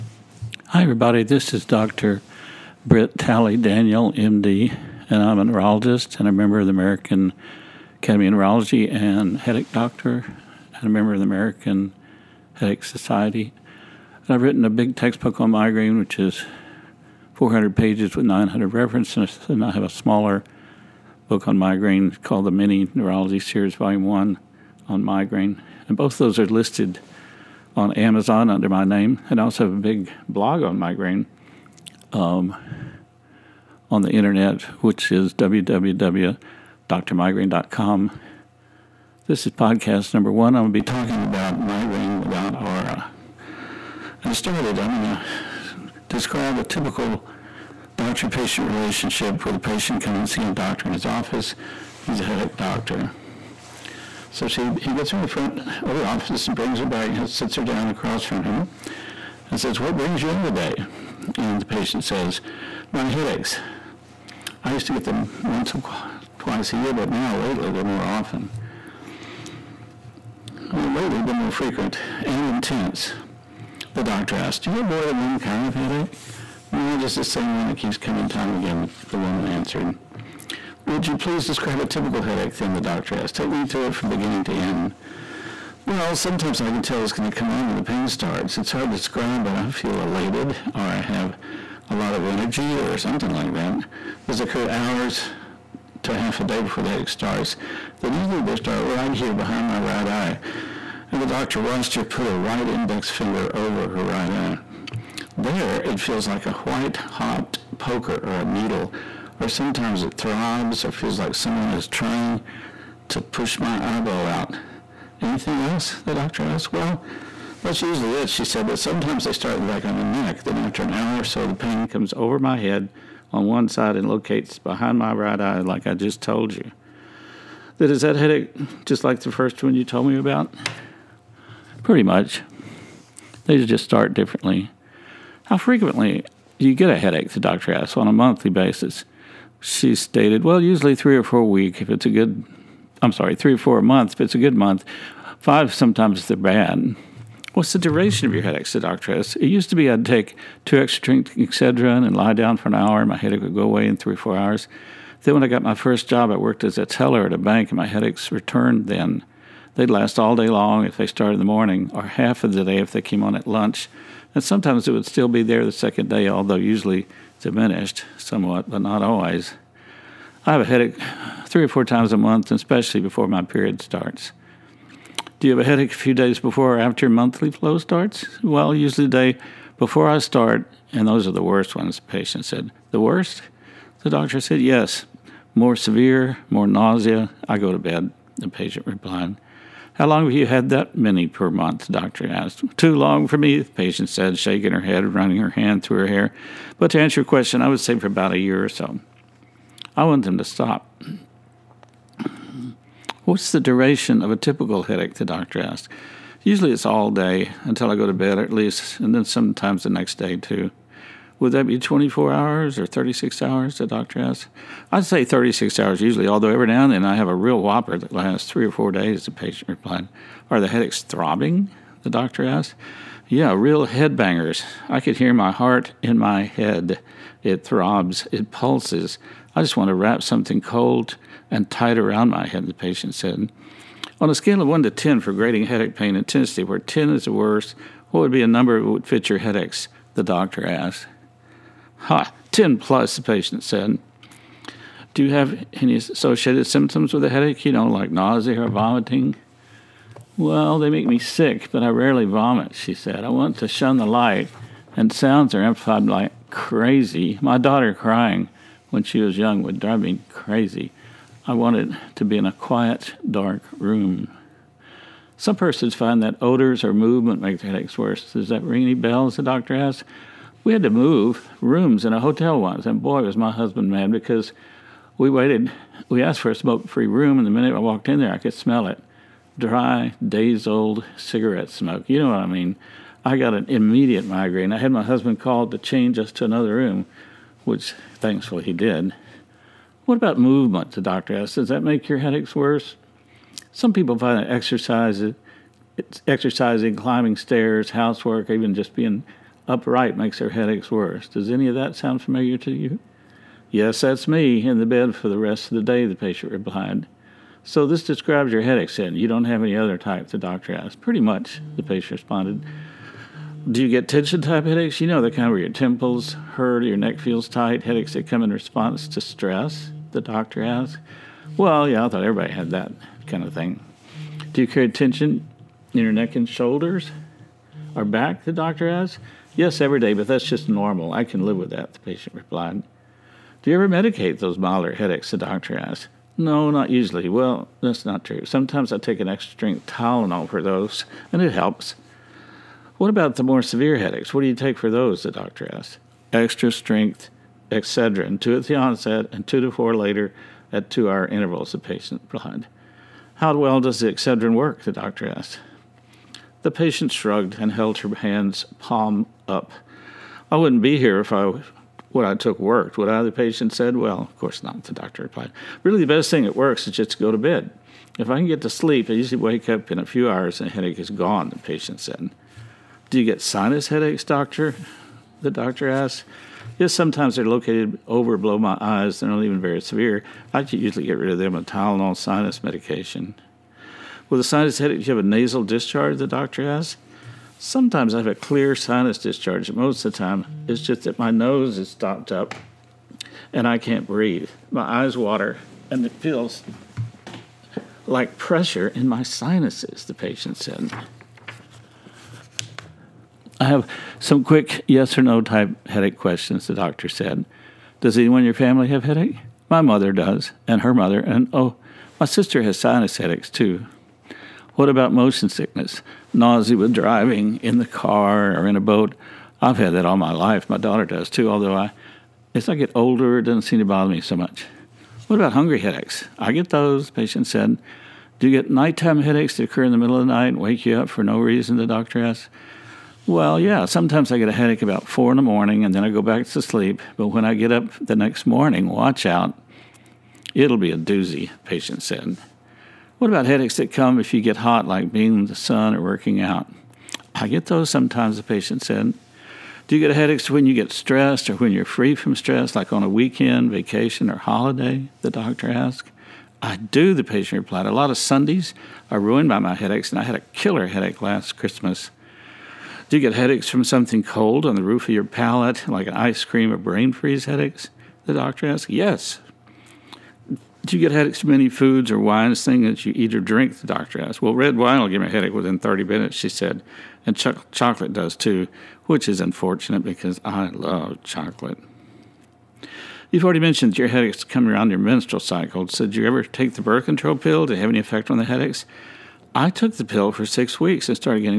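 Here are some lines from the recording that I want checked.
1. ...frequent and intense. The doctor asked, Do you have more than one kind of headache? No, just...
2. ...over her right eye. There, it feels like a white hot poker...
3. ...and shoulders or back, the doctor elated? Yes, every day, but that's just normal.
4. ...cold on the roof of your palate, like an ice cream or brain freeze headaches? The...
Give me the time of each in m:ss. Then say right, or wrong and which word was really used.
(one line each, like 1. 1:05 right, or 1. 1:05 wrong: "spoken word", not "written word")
1. 1:11 right
2. 1:43 right
3. 5:26 wrong: "asked", not "elated"
4. 7:44 right.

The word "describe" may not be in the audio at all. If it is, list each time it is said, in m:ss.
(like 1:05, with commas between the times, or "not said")
0:46, 1:21, 1:28, 5:08.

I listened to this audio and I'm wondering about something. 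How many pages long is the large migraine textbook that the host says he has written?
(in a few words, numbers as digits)
400.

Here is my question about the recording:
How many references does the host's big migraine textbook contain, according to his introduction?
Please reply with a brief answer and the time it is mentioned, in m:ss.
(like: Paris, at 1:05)
900, at 0:18.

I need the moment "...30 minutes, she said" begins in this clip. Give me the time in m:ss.
7:55.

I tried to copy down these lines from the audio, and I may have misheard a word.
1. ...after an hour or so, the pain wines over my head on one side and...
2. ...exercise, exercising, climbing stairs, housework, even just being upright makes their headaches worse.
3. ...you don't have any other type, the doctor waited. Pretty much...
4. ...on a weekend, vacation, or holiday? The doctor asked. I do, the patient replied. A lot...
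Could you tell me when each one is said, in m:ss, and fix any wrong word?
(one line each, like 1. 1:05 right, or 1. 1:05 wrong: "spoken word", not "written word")
1. 2:00 wrong: "comes", not "wines"
2. 4:54 right
3. 5:09 wrong: "asked", not "waited"
4. 7:32 right.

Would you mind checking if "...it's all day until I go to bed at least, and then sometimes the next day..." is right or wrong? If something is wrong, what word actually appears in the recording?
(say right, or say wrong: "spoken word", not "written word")
right.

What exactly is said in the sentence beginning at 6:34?
My eyes water and it feels like pressure in my sinuses, the patient said.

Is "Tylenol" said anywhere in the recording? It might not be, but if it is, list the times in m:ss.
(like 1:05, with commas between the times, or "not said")
5:39, 6:21.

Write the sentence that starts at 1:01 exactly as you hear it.
And the patient says, My headaches.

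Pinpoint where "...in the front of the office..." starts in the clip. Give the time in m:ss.
0:55.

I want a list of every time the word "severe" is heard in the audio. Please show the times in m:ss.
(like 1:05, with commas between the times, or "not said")
3:05, 5:43, 6:19.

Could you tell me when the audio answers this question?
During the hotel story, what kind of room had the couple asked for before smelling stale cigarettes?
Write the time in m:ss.
4:36.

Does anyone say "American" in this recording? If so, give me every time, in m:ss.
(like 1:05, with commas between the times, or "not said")
0:06, 0:11.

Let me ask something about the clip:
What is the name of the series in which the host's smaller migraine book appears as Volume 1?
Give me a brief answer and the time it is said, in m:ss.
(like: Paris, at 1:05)
The Mini Neurology Series, at 0:22.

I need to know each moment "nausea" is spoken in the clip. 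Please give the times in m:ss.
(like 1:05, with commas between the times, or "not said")
3:06, 4:08, 6:56.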